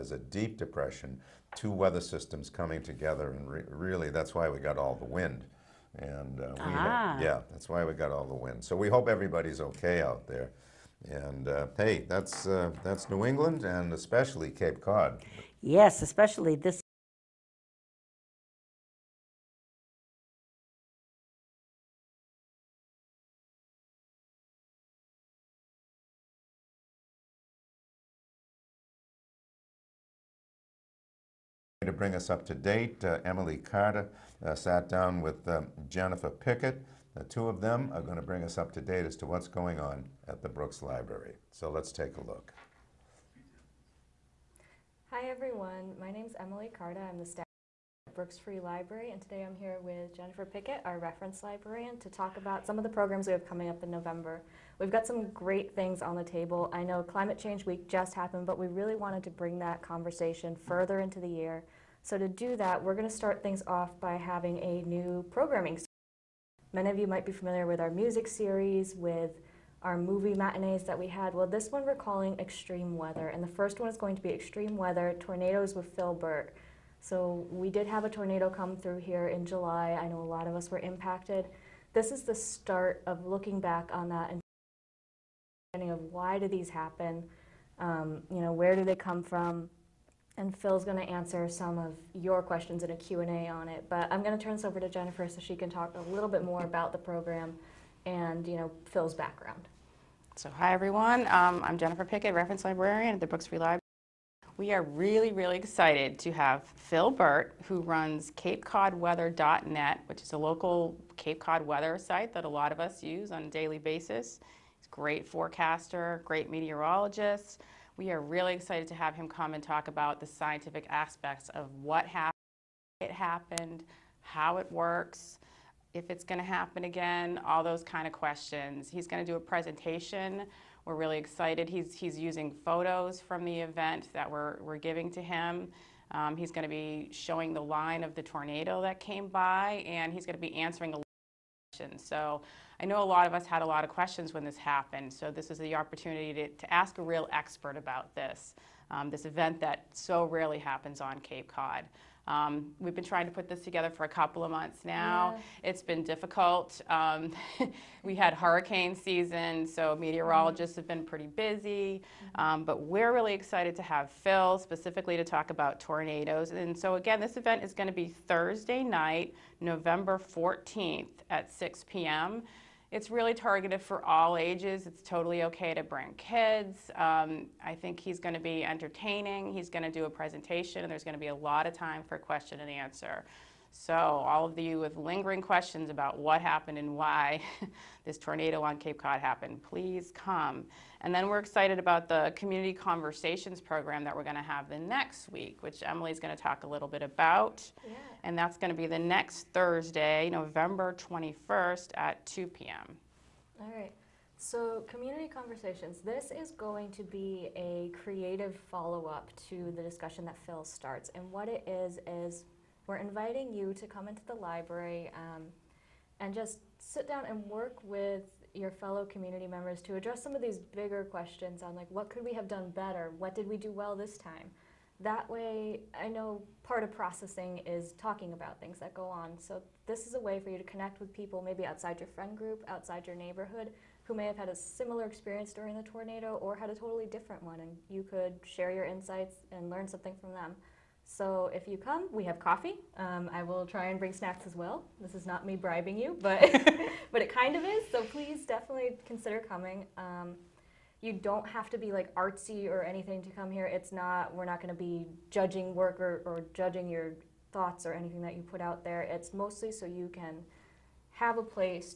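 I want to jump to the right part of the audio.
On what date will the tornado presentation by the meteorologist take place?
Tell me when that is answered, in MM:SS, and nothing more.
02:49.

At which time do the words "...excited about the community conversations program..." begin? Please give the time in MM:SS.
03:11.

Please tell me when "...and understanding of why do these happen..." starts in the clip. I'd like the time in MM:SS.
01:24.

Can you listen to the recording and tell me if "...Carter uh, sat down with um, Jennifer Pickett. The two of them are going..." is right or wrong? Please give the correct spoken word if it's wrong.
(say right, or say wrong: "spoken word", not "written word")
right.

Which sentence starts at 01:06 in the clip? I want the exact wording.
Many of you might be familiar with our music series, with our movie matinees that we had.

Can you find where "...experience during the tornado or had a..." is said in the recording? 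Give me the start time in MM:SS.
03:55.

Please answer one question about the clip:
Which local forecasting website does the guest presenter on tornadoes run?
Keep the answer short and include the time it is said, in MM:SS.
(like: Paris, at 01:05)
CapeCodWeather.net, at 01:48.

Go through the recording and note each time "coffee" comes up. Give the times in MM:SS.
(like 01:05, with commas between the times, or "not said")
04:02.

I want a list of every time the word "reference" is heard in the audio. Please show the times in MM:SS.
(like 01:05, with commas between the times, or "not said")
00:50, 01:42.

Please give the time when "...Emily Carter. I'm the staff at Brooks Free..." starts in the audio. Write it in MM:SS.
00:46.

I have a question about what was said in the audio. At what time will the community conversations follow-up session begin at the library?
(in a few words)
2 p.m.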